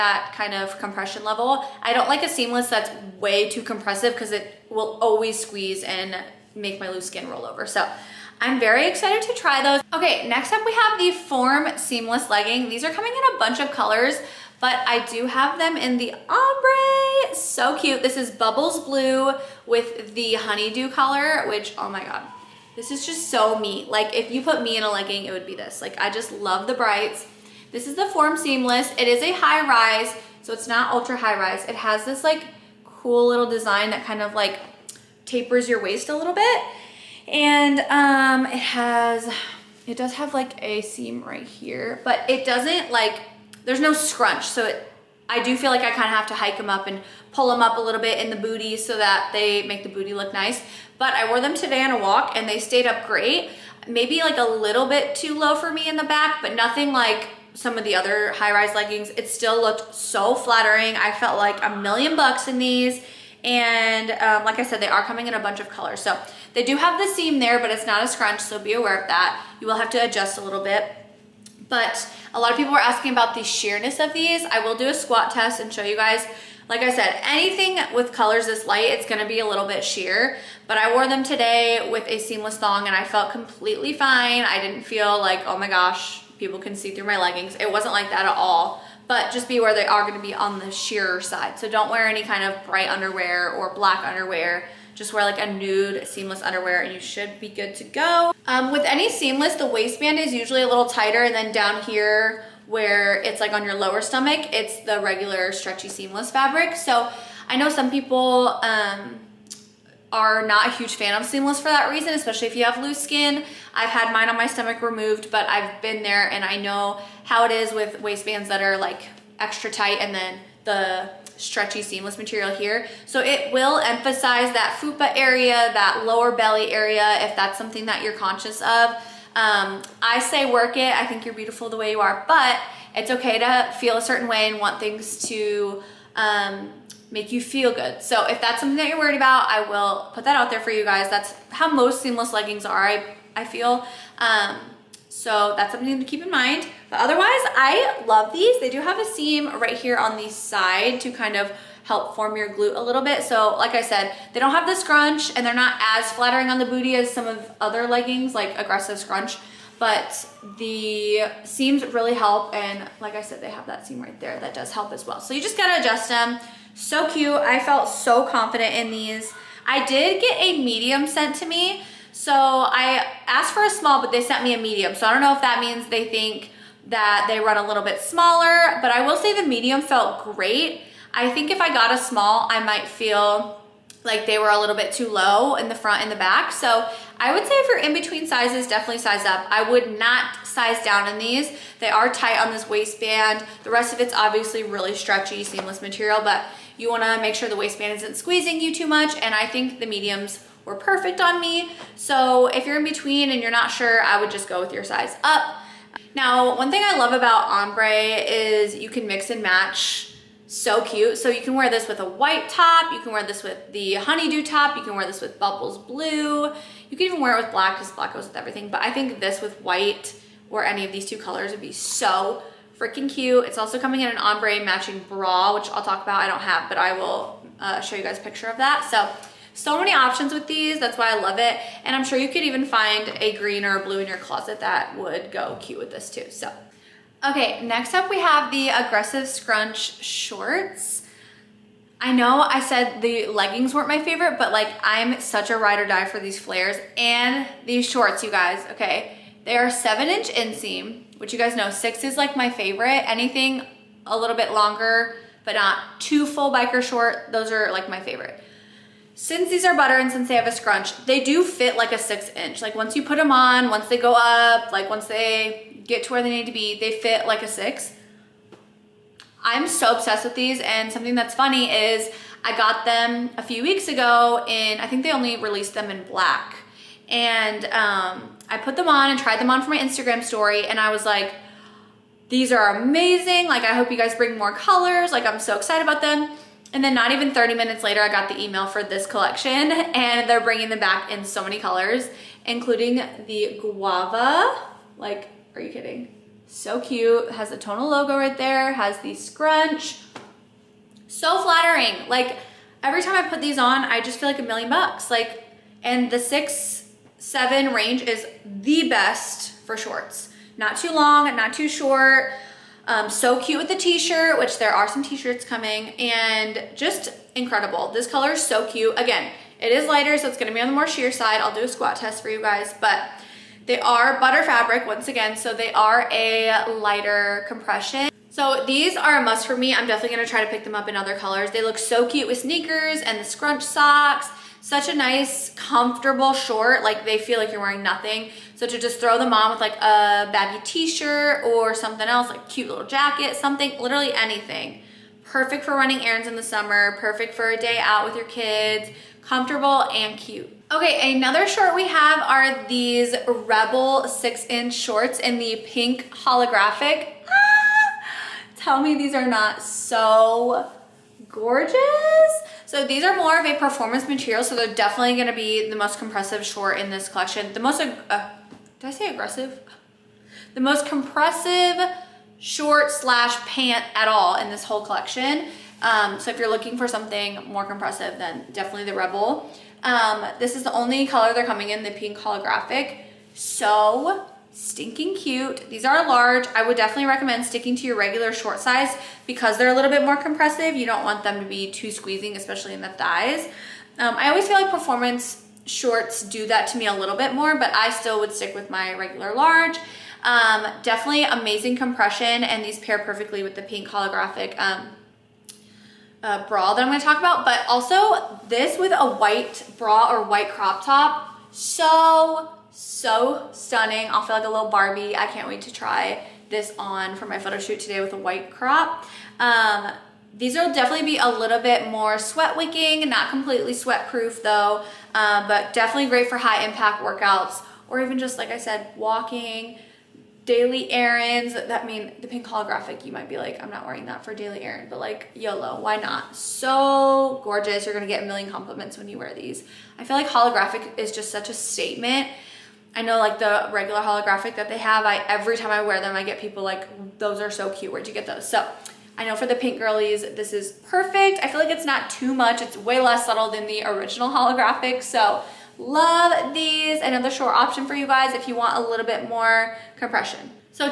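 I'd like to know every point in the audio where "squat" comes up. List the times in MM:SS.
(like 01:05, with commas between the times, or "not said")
01:14, 05:21.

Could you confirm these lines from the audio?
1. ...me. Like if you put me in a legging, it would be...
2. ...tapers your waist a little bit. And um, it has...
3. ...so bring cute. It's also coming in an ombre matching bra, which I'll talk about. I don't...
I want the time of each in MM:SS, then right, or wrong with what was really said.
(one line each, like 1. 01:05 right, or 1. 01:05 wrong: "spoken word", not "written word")
1. 00:23 right
2. 00:35 right
3. 03:41 wrong: "freaking", not "bring".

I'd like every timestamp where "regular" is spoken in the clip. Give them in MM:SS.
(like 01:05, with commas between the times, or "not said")
01:44, 06:27, 06:38, 07:23.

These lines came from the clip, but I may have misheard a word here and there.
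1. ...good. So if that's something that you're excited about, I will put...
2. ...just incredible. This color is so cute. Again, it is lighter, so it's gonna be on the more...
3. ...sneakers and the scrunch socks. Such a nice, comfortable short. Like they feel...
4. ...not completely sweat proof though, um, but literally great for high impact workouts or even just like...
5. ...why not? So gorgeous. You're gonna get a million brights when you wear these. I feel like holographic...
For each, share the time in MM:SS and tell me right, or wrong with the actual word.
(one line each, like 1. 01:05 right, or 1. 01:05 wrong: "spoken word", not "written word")
1. 02:17 wrong: "worried", not "excited"
2. 05:16 right
3. 05:32 right
4. 07:03 wrong: "definitely", not "literally"
5. 07:15 wrong: "compliments", not "brights".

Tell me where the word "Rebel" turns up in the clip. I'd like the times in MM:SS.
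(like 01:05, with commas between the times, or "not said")
05:53, 06:18.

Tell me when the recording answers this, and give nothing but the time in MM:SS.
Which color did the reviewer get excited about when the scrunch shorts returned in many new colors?
04:53.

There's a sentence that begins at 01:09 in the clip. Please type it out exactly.
You will have to adjust a little bit.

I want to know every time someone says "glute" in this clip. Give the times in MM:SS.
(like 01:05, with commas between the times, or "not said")
02:32.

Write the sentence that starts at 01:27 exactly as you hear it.
It wasn't like that at all but just be aware they are gonna be on the sheerer side.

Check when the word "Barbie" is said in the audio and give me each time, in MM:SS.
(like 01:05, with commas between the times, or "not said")
06:54.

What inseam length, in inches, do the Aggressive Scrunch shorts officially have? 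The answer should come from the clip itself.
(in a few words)
7.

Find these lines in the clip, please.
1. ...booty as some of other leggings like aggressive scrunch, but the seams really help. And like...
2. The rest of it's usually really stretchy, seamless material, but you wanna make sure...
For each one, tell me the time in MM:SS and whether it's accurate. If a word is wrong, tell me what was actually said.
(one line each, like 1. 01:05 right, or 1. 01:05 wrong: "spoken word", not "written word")
1. 02:36 right
2. 03:13 wrong: "obviously", not "usually".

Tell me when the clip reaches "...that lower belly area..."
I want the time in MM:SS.
02:05.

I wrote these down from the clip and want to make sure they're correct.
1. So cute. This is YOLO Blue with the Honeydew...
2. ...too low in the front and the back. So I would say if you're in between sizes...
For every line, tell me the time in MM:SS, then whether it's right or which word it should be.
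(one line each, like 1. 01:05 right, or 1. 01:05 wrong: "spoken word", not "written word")
1. 00:17 wrong: "Bubbles", not "YOLO"
2. 03:04 right.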